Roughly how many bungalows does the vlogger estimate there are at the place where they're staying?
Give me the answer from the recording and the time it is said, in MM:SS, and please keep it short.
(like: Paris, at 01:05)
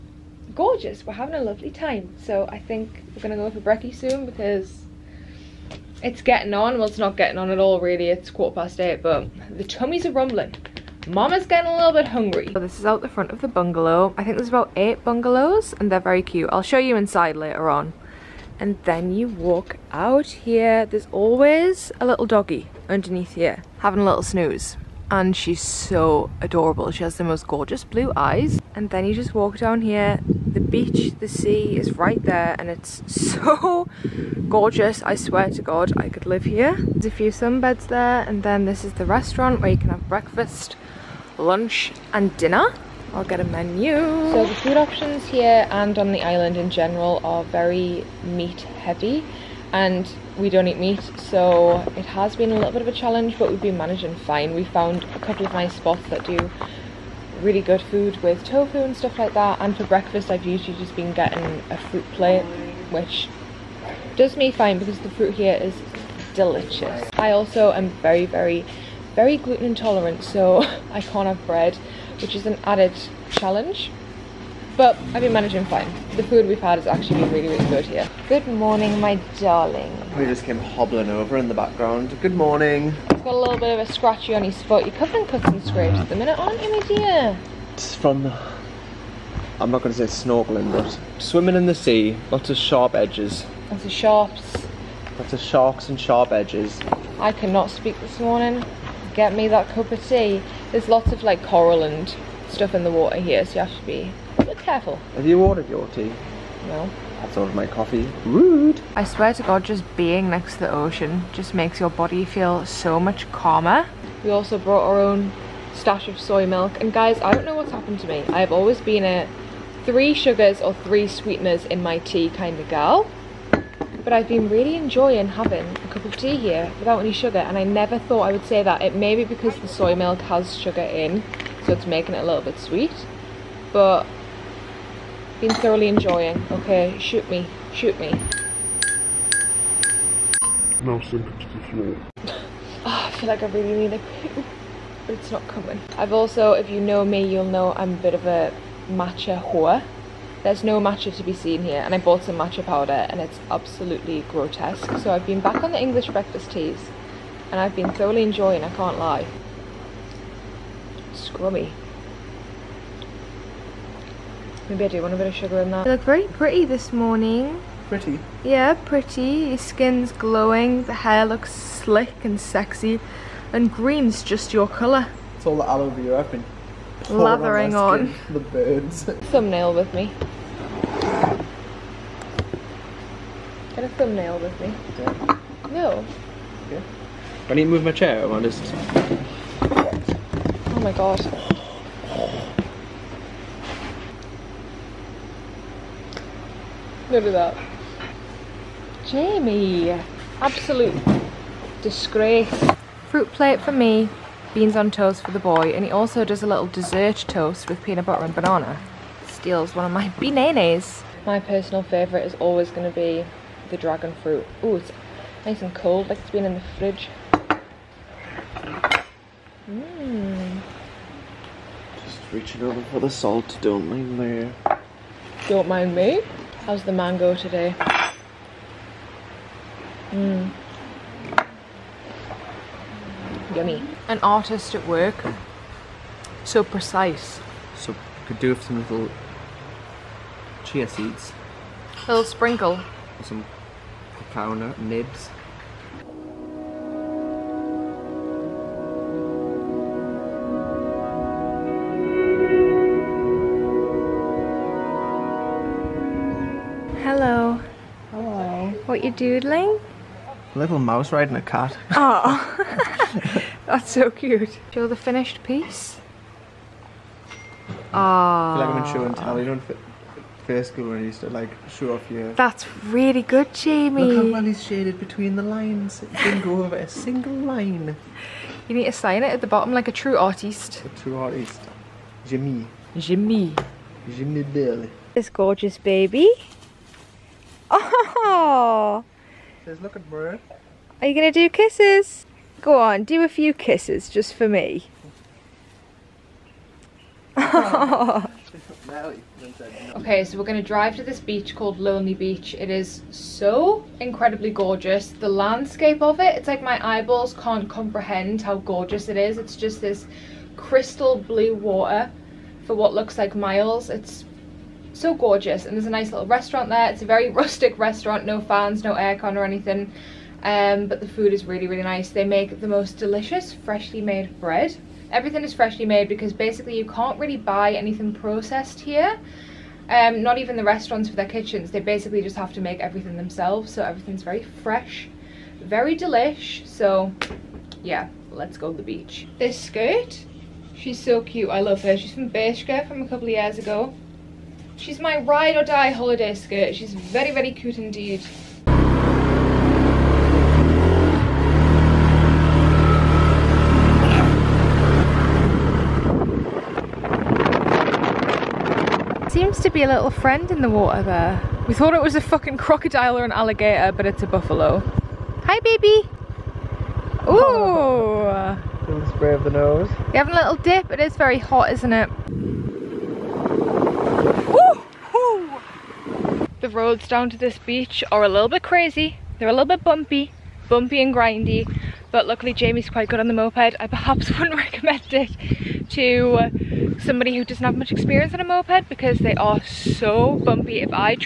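8, at 00:14.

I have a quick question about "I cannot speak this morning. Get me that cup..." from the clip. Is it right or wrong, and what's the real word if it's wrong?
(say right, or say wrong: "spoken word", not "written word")
right.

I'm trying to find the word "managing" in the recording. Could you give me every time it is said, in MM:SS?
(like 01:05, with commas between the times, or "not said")
00:53, 01:15.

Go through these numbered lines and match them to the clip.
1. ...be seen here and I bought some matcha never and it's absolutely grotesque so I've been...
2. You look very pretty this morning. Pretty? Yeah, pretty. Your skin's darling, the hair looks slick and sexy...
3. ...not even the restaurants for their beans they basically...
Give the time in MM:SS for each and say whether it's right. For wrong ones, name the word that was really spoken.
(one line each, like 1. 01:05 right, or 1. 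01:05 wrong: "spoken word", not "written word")
1. 02:31 wrong: "powder", not "never"
2. 02:45 wrong: "glowing", not "darling"
3. 05:30 wrong: "kitchens", not "beans".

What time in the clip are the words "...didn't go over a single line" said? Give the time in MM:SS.
04:36.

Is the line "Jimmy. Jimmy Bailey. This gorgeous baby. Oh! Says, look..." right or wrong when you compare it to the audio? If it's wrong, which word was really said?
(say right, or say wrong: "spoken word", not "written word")
right.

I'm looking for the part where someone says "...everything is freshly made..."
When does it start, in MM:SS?
05:25.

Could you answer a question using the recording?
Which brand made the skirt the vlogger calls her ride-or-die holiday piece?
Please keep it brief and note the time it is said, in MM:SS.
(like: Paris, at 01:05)
Bershka, at 05:42.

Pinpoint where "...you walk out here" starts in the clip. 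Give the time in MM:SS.
00:19.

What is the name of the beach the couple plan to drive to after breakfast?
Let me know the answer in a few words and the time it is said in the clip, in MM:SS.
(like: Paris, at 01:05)
Lonely Beach, at 05:01.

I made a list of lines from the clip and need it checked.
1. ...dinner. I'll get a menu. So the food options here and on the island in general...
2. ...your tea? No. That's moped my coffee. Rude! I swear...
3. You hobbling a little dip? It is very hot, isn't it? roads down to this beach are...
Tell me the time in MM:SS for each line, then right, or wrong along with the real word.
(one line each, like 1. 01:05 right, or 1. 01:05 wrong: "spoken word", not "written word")
1. 00:42 right
2. 01:45 wrong: "ordered", not "moped"
3. 06:10 wrong: "having", not "hobbling".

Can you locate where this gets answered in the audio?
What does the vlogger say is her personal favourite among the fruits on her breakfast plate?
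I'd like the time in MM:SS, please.
03:33.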